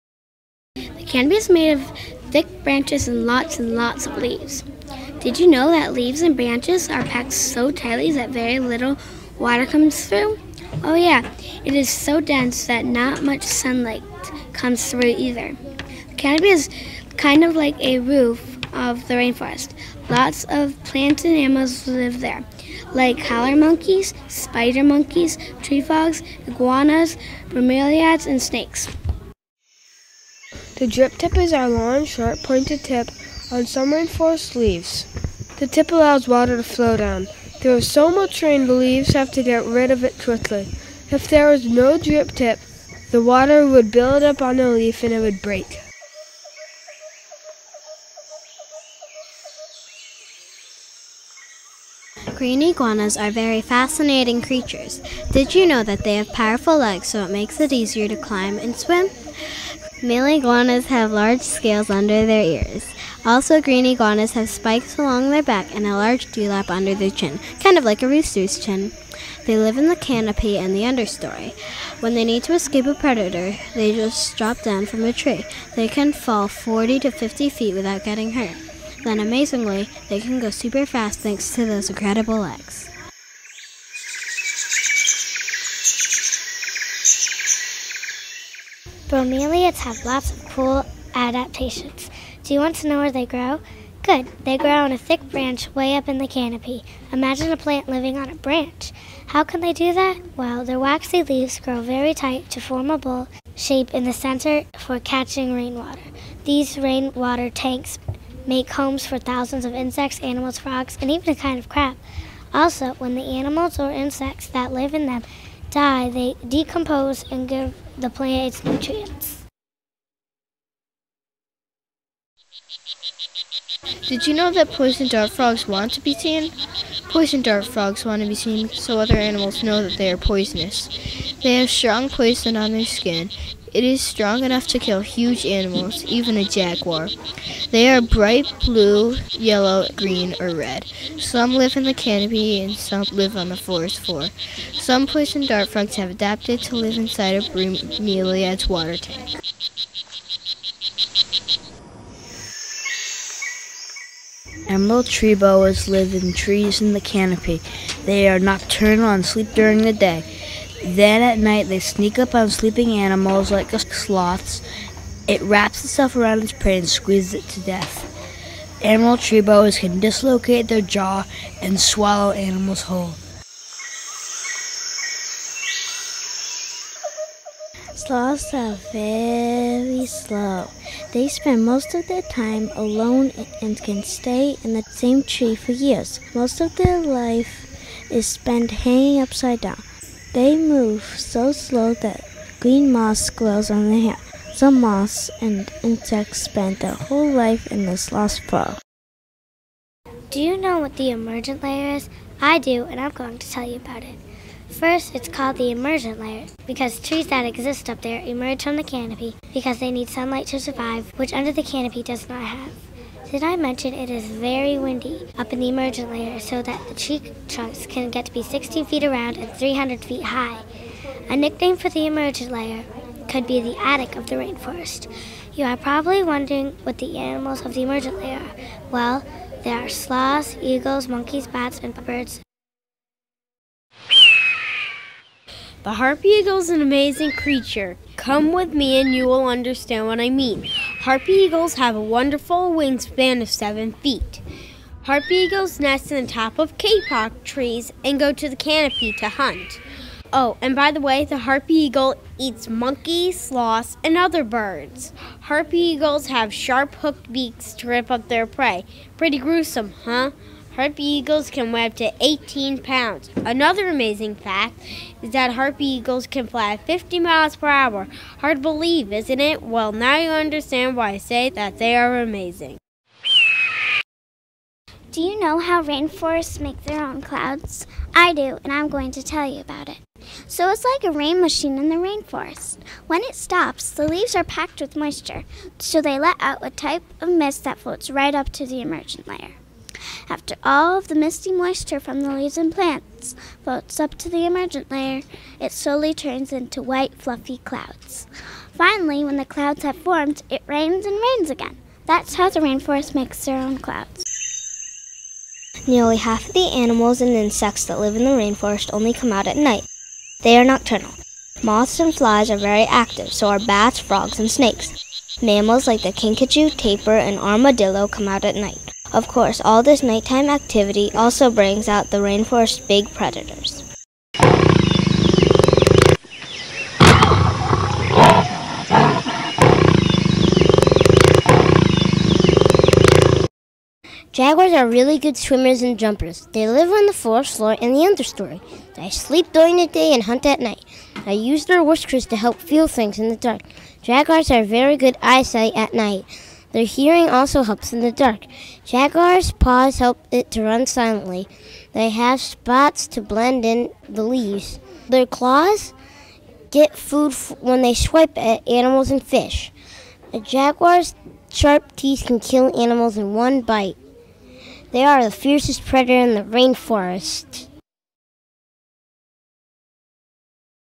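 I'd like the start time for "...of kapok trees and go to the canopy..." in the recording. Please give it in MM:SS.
04:06.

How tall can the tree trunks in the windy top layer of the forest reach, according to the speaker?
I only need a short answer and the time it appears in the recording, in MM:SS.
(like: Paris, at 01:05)
300 feet, at 03:39.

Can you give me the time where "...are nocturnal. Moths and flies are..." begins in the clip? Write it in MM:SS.
05:10.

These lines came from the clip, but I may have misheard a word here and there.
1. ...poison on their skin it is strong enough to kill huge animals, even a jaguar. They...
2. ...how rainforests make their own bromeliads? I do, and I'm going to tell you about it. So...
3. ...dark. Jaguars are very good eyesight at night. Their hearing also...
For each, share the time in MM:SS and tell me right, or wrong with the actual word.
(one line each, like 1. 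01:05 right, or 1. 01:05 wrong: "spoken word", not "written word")
1. 02:12 right
2. 04:35 wrong: "clouds", not "bromeliads"
3. 05:43 right.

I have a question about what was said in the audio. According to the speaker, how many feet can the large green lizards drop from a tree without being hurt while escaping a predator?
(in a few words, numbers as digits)
40 to 50 feet.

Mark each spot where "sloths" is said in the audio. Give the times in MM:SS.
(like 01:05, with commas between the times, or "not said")
02:43, 02:57, 03:49, 04:13.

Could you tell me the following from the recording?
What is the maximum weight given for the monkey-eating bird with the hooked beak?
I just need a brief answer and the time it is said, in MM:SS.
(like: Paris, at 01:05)
18 pounds, at 04:22.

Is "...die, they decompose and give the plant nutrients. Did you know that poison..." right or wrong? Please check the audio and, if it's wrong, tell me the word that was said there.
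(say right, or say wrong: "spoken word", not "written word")
right.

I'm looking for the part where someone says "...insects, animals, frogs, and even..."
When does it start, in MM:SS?
01:49.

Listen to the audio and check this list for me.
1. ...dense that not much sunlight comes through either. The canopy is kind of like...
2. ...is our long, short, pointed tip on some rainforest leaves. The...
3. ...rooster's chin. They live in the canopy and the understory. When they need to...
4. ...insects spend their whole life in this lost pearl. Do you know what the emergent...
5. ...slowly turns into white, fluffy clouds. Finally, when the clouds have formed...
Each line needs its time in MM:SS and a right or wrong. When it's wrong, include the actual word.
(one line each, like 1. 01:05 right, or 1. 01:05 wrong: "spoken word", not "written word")
1. 00:12 right
2. 00:31 right
3. 01:08 right
4. 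03:15 right
5. 04:55 right.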